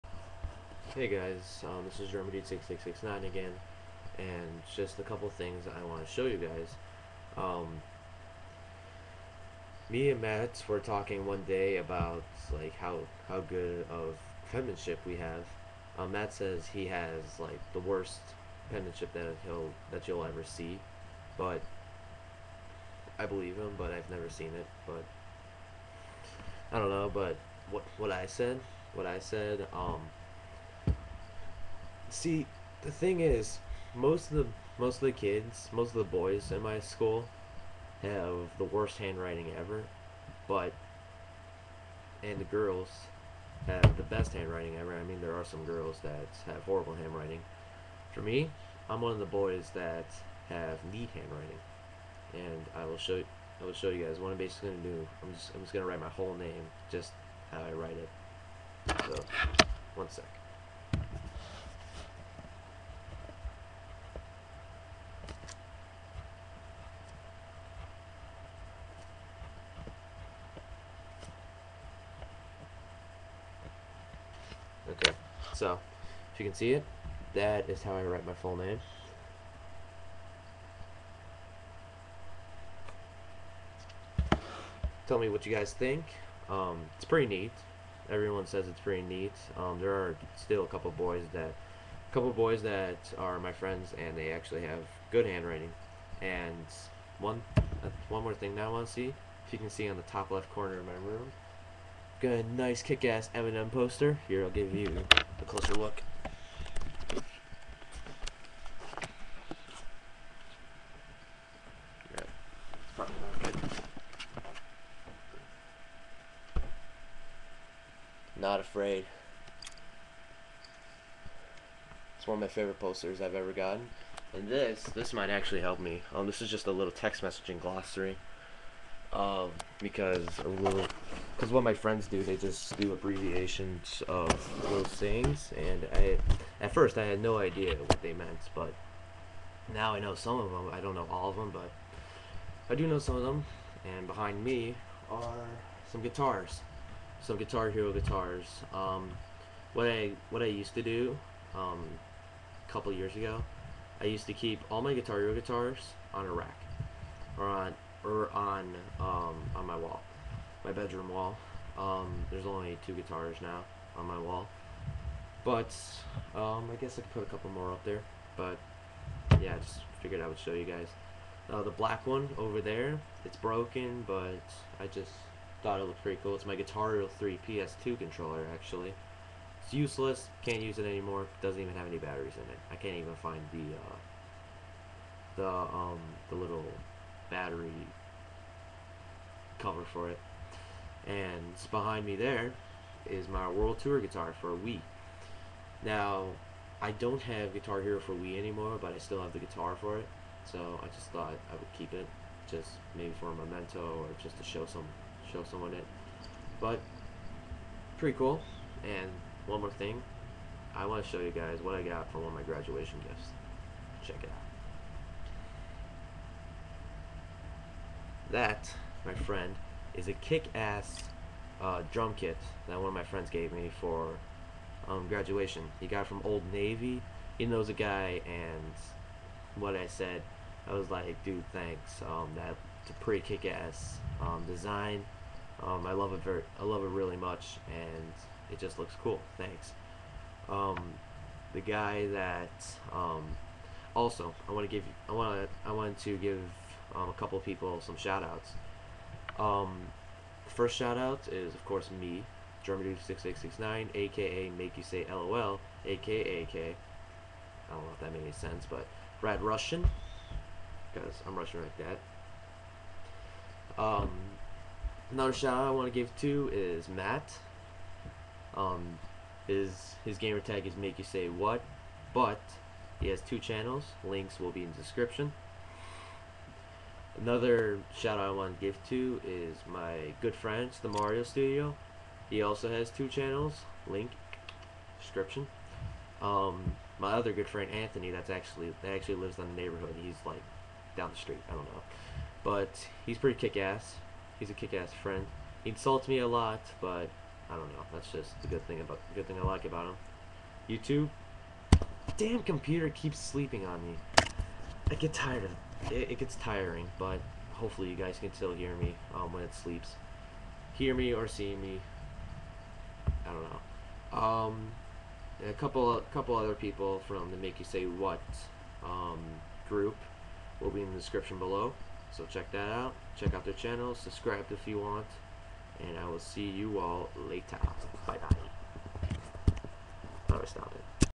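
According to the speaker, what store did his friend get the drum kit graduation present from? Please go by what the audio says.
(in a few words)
Old Navy.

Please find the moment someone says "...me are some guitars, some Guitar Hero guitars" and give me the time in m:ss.
2:24.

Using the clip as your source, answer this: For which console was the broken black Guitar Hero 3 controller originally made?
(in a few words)
PS2.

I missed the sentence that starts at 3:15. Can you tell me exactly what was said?
Now, I don't have Guitar Hero for Wii anymore, but I still have the guitar for it.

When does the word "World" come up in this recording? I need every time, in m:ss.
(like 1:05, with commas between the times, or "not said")
3:13.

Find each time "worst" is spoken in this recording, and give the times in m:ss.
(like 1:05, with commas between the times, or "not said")
0:17, 0:38.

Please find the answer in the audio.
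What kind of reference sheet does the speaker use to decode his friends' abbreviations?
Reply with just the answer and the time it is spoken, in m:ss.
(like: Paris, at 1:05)
text messaging glossary, at 2:06.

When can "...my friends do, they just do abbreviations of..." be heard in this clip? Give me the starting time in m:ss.
2:11.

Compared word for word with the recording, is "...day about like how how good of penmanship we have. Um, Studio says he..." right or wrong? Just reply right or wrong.
wrong.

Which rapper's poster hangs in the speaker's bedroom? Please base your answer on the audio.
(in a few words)
Eminem.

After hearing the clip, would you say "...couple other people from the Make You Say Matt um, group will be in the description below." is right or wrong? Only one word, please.
wrong.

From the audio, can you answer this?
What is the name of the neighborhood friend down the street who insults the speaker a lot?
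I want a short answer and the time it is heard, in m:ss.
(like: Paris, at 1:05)
Anthony, at 4:47.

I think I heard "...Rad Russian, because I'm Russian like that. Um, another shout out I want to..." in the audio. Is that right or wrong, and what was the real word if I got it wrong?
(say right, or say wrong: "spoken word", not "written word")
right.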